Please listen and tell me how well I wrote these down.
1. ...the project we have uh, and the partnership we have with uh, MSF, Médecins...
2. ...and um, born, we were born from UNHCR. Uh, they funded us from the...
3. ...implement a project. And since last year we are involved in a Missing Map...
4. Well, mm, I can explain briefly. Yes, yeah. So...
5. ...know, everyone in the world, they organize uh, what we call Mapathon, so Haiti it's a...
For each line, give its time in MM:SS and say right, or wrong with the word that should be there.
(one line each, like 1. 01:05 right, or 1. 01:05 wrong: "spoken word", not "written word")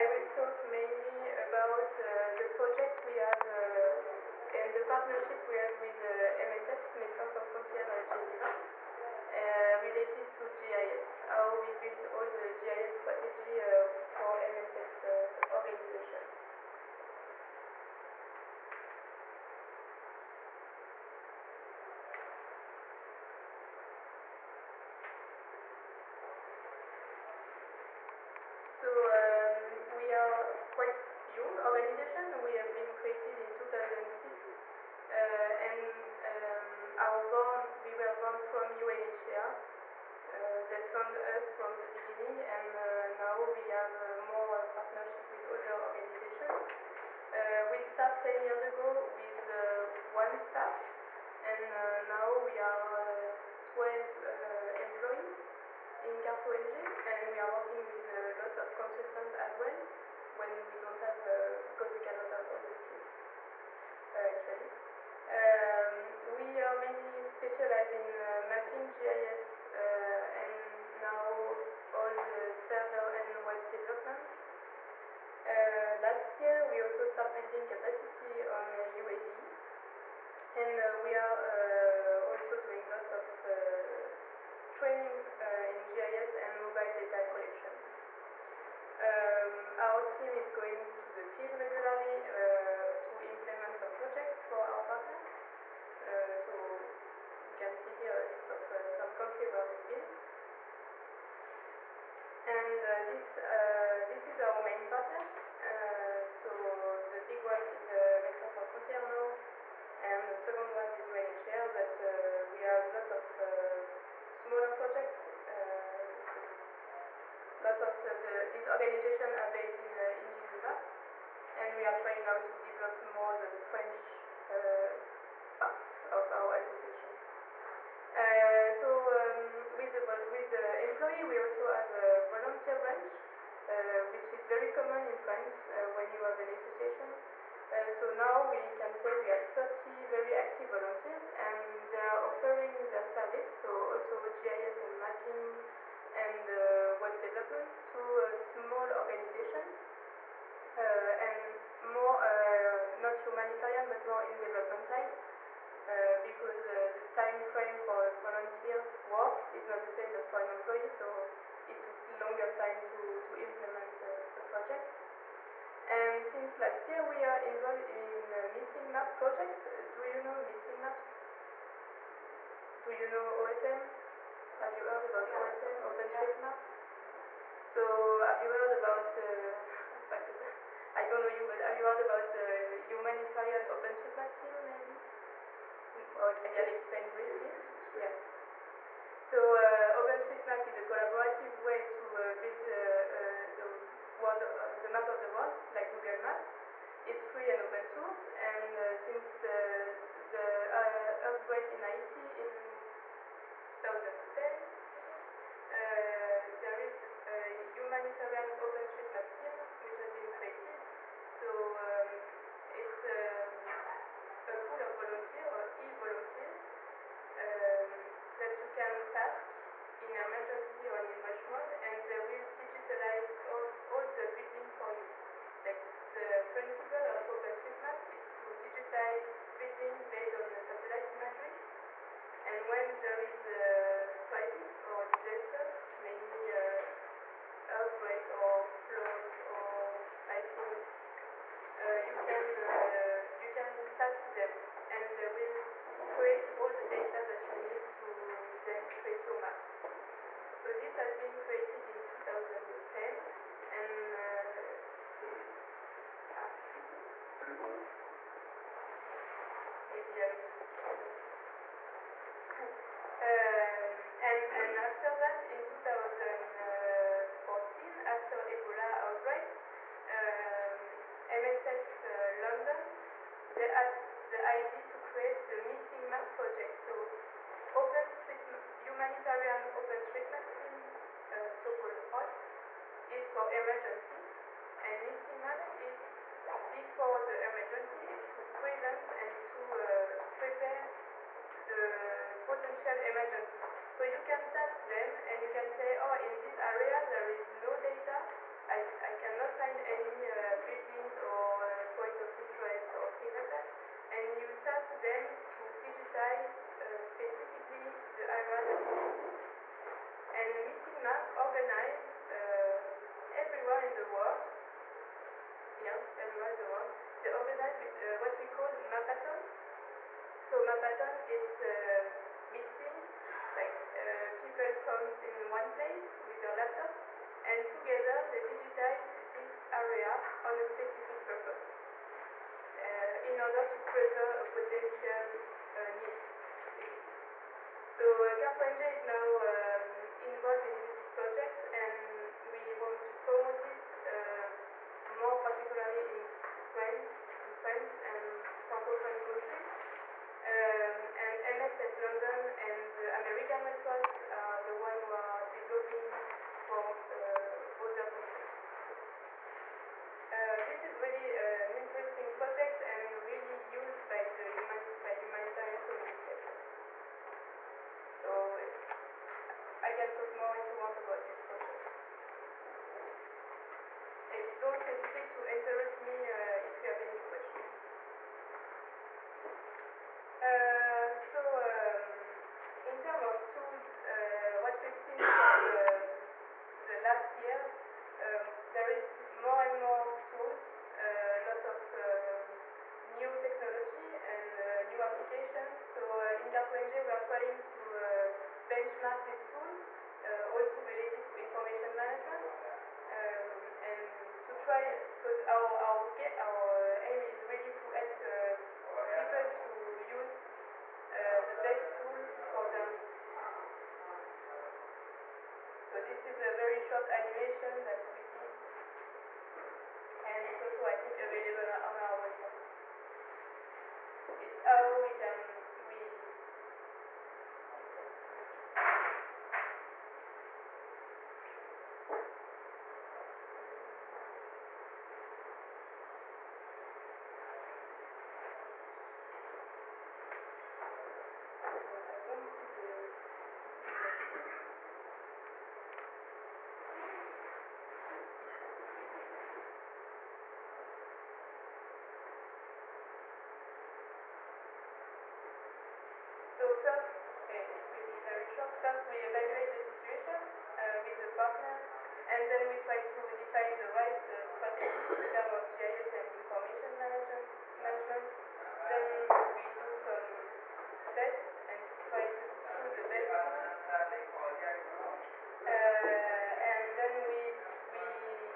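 1. 00:02 right
2. 00:35 right
3. 02:43 right
4. 03:06 right
5. 05:15 wrong: "Mapathon", not "Haiti".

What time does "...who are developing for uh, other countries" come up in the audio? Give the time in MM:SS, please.
05:55.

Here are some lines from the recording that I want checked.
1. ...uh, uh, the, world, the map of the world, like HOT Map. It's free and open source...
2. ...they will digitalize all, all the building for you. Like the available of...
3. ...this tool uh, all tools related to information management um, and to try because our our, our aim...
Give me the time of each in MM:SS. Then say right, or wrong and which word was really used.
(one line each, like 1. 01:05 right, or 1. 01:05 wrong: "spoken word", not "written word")
1. 03:12 wrong: "Google", not "HOT"
2. 03:42 wrong: "principle", not "available"
3. 06:39 right.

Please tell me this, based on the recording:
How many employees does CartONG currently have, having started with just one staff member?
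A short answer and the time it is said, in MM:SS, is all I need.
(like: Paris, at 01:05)
12, at 00:53.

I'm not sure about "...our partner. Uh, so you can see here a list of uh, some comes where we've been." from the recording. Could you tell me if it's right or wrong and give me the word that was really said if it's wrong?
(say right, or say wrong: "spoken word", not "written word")
wrong: "countries", not "comes".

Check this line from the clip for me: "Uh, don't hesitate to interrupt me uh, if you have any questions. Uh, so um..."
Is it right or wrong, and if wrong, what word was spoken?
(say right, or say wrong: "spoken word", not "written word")
right.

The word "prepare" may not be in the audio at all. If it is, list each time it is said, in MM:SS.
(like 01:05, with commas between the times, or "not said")
04:50, 05:33.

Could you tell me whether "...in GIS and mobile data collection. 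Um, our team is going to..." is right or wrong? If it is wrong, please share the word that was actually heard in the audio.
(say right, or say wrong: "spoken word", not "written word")
right.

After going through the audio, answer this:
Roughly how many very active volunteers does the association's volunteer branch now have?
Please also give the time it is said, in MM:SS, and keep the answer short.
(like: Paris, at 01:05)
30, at 02:19.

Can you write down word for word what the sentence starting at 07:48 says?
Then we do some tests and try to choose the best tool.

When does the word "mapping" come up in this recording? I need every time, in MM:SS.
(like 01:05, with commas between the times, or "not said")
01:08, 02:24.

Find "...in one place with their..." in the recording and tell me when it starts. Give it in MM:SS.
05:25.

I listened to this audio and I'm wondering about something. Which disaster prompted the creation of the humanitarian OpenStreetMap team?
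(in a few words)
earthquake in Haiti.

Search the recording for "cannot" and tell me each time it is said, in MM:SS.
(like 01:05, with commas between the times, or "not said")
01:01, 04:59.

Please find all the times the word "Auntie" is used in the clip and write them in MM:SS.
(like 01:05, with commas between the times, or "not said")
not said.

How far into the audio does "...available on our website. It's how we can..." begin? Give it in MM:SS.
07:01.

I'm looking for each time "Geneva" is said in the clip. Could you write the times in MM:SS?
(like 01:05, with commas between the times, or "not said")
00:08, 02:00.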